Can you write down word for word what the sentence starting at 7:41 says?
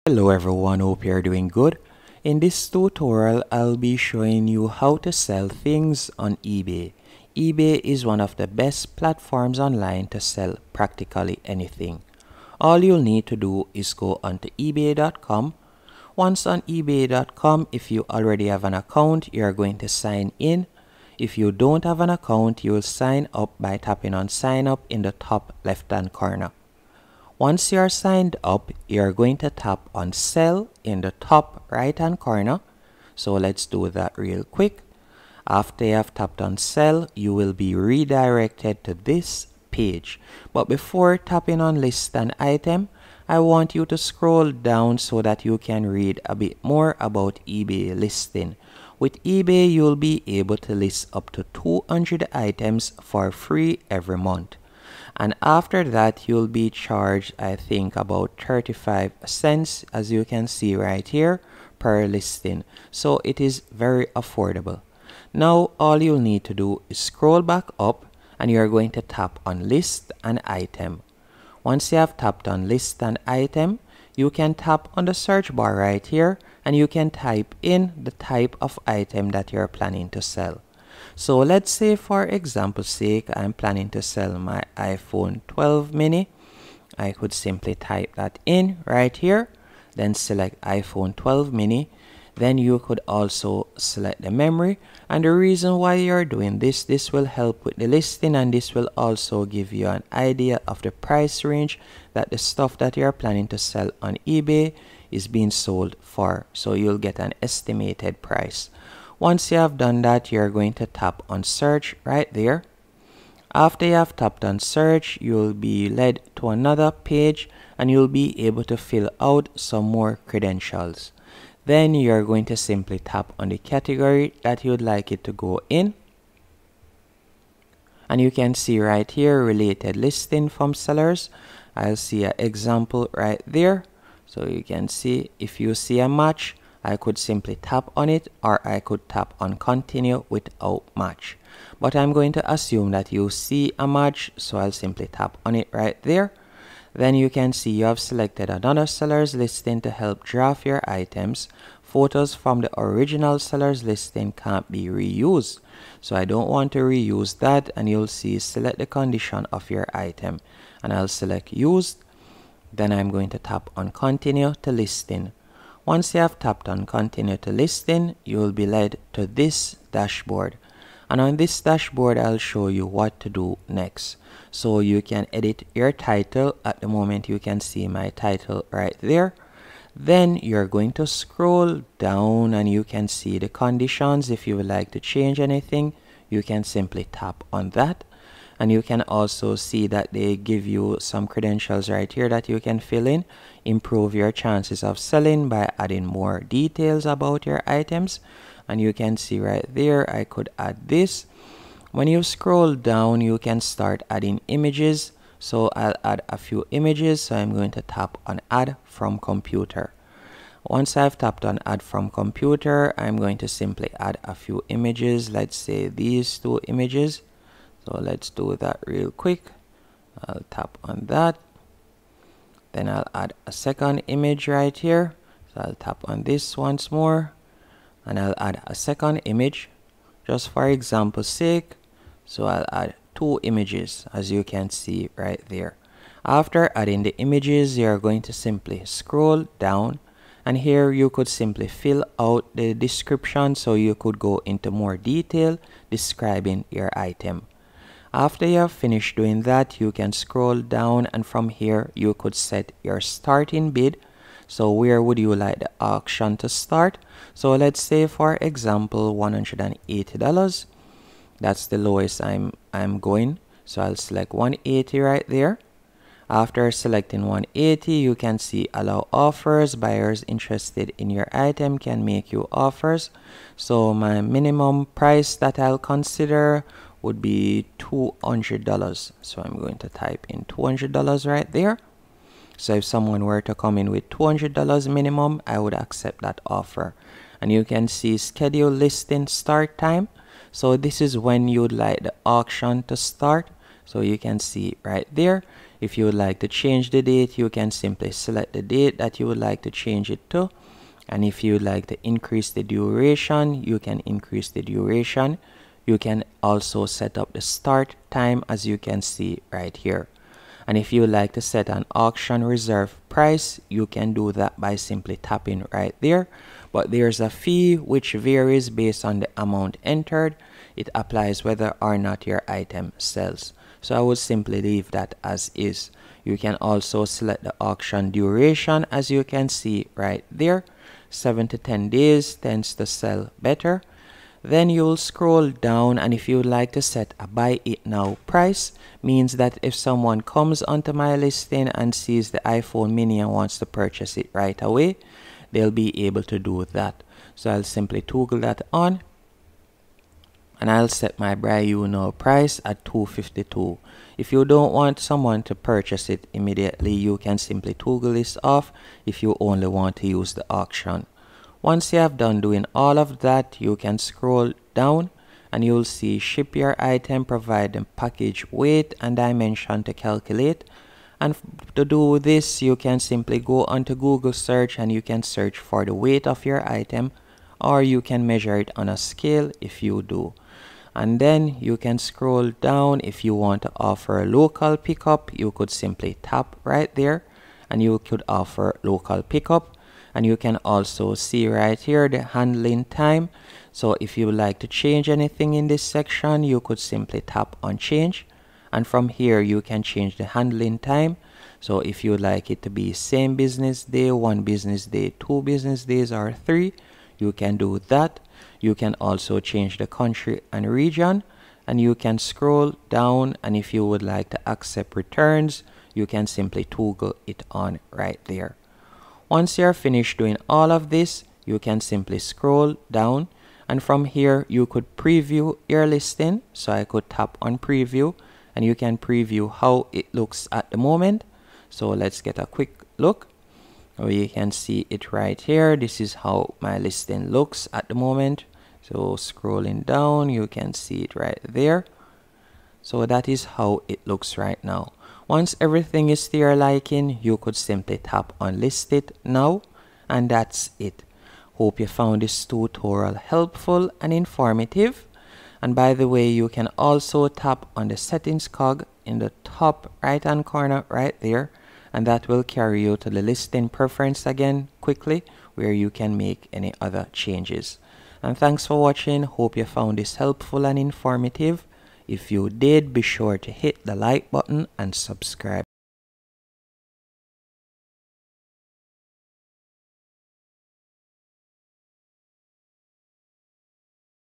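And that will carry you to the listing preference again quickly where you can make any other changes.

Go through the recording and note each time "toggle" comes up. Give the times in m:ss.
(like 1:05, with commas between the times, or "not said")
5:48, 5:57, 6:56.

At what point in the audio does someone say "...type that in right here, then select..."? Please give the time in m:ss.
1:27.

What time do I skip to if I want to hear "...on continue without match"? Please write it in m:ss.
2:19.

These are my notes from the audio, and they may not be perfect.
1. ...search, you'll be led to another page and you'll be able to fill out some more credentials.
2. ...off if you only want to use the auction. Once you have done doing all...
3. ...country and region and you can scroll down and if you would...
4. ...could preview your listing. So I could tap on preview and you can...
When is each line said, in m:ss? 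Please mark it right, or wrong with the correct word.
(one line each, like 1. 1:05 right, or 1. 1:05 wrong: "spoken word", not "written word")
1. 1:54 right
2. 5:58 right
3. 6:49 right
4. 7:04 right.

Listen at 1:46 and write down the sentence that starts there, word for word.
So you'll get an estimated price.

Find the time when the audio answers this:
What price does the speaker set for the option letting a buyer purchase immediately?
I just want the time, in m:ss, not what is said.
5:52.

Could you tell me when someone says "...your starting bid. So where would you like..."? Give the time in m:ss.
4:12.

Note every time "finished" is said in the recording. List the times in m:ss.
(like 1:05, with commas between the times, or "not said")
4:08, 6:59.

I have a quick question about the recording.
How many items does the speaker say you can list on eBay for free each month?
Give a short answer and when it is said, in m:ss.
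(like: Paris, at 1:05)
200, at 0:51.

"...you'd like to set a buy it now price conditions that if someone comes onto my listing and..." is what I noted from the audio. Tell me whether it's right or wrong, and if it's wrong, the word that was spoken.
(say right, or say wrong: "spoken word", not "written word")
wrong: "means", not "conditions".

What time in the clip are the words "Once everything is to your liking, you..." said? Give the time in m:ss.
7:25.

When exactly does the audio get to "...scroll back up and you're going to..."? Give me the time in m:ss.
1:06.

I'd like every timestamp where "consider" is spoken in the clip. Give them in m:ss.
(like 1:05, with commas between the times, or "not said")
4:35.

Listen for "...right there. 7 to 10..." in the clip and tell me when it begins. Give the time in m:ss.
5:29.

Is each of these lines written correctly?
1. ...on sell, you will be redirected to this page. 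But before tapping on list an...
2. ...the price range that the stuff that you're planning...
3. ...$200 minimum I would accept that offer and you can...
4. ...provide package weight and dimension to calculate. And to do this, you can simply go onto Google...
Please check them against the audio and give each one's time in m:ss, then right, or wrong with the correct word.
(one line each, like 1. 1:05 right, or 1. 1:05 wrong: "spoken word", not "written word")
1. 0:36 right
2. 1:40 right
3. 4:44 right
4. 6:07 right.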